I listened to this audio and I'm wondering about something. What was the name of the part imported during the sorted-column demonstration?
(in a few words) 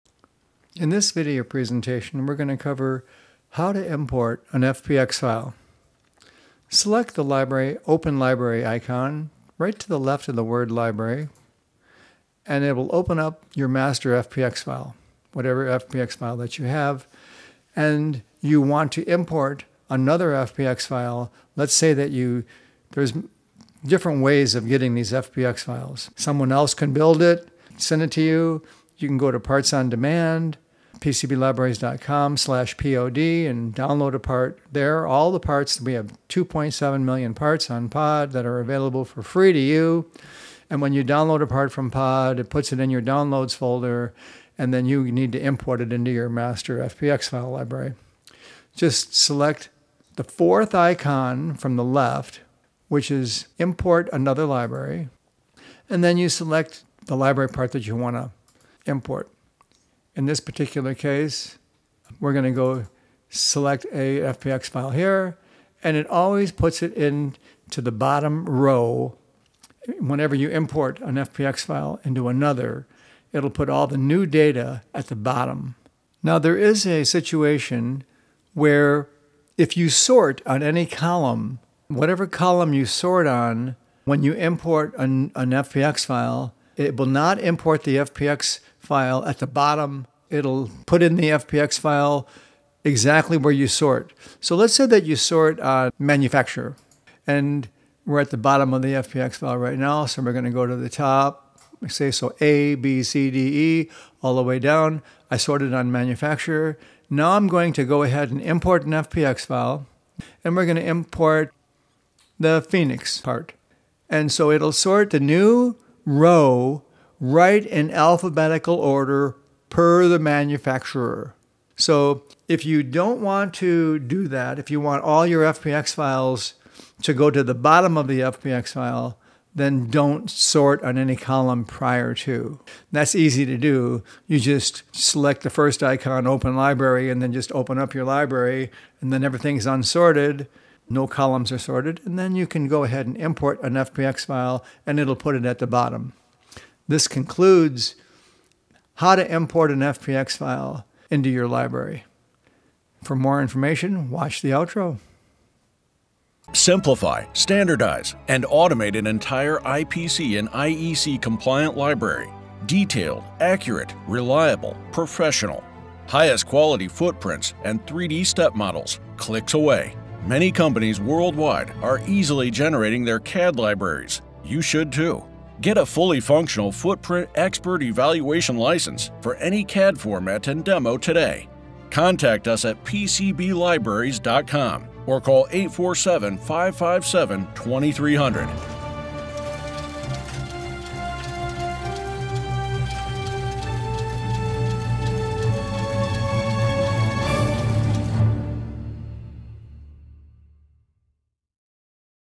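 Phoenix.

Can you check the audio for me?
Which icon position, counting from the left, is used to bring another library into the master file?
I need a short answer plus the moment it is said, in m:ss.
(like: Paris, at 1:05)
fourth, at 0:50.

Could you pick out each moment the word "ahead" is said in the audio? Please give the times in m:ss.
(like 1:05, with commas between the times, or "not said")
1:48, 2:22.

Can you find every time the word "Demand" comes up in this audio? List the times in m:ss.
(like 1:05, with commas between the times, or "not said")
0:29.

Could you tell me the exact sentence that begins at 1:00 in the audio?
In this particular case, we're going to go select a Fpx file here, and it always puts it into the bottom row.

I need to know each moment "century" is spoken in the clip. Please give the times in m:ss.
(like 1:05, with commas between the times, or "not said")
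not said.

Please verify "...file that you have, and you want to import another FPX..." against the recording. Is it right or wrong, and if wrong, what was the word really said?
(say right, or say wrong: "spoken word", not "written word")
right.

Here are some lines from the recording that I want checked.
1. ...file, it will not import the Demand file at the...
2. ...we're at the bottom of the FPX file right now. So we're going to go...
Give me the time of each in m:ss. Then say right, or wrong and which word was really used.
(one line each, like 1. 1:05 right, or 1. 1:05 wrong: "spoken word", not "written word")
1. 1:26 wrong: "FPX", not "Demand"
2. 1:38 right.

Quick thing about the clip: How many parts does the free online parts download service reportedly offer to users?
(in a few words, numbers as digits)
2.7 million.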